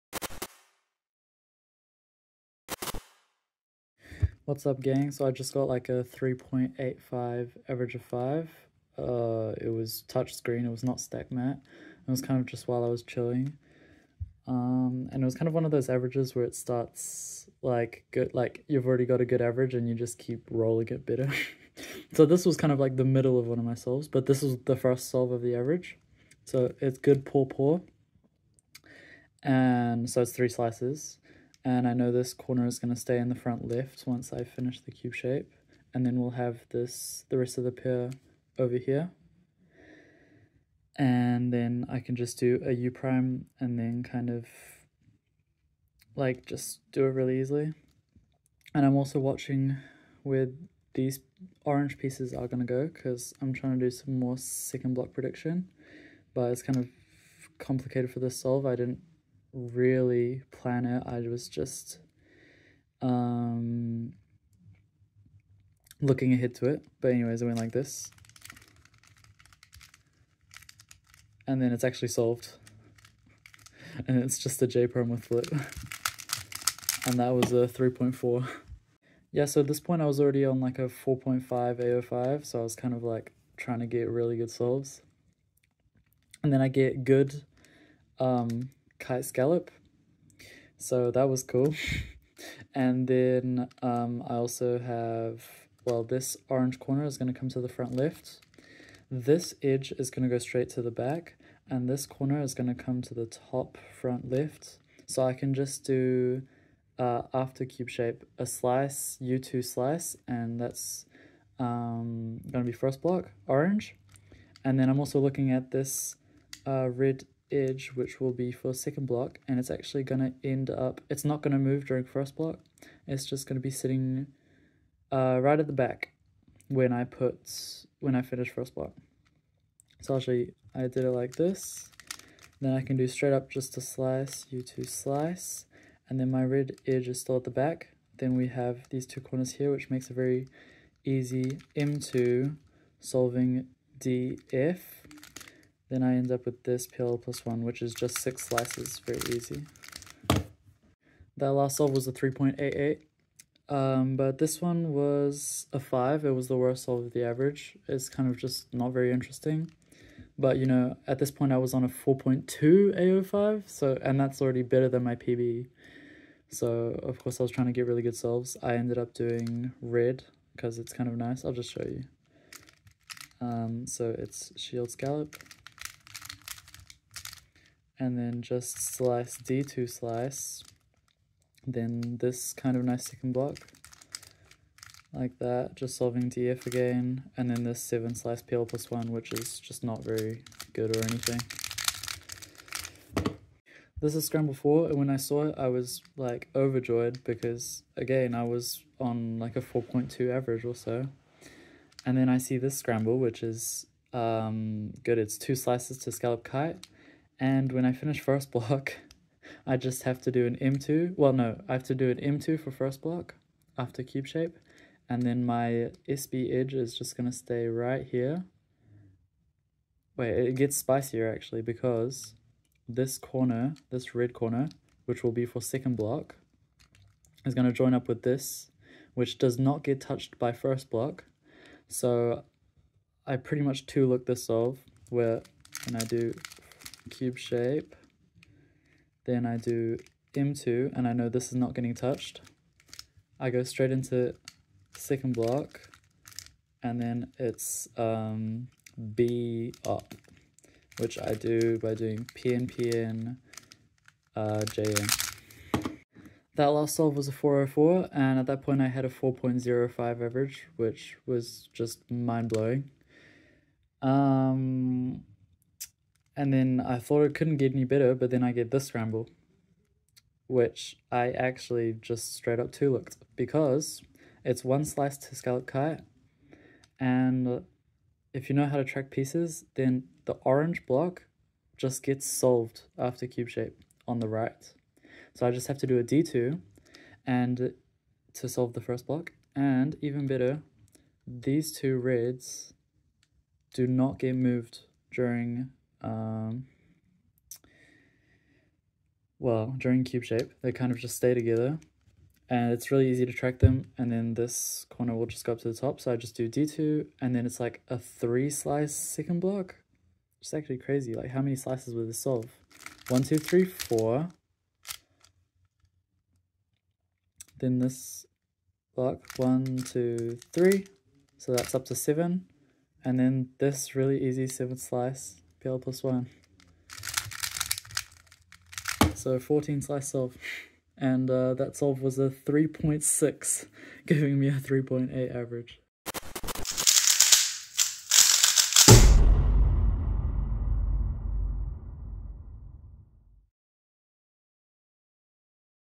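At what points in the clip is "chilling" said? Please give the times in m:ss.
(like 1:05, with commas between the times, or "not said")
0:13.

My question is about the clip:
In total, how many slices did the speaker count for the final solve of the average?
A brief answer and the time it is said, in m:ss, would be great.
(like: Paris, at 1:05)
14, at 5:29.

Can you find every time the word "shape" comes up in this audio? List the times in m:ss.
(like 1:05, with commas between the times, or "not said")
0:35, 1:47, 3:34, 3:57, 4:43, 5:00.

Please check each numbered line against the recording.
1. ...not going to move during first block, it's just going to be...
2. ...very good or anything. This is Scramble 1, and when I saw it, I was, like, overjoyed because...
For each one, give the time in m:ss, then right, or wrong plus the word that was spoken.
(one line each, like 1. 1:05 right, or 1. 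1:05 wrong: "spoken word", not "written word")
1. 2:01 right
2. 3:10 wrong: "4", not "1".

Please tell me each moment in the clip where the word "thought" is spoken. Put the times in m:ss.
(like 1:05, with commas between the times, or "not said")
4:26.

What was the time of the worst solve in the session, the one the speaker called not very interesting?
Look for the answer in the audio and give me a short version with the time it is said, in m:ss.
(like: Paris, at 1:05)
5, at 2:35.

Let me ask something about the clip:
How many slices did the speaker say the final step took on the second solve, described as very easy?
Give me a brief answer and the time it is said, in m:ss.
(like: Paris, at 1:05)
6, at 2:28.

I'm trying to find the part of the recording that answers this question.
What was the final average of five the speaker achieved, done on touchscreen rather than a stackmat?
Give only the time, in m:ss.
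0:06.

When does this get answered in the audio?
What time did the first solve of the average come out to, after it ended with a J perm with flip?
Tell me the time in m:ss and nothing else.
1:17.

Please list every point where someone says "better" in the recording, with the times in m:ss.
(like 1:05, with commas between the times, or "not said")
0:21, 2:44, 4:27, 4:50.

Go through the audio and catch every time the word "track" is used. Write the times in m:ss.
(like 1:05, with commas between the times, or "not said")
4:38, 5:03.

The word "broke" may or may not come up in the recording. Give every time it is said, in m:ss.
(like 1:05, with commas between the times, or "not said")
not said.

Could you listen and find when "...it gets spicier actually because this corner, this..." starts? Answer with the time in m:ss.
3:40.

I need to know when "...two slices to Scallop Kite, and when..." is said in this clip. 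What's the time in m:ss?
3:25.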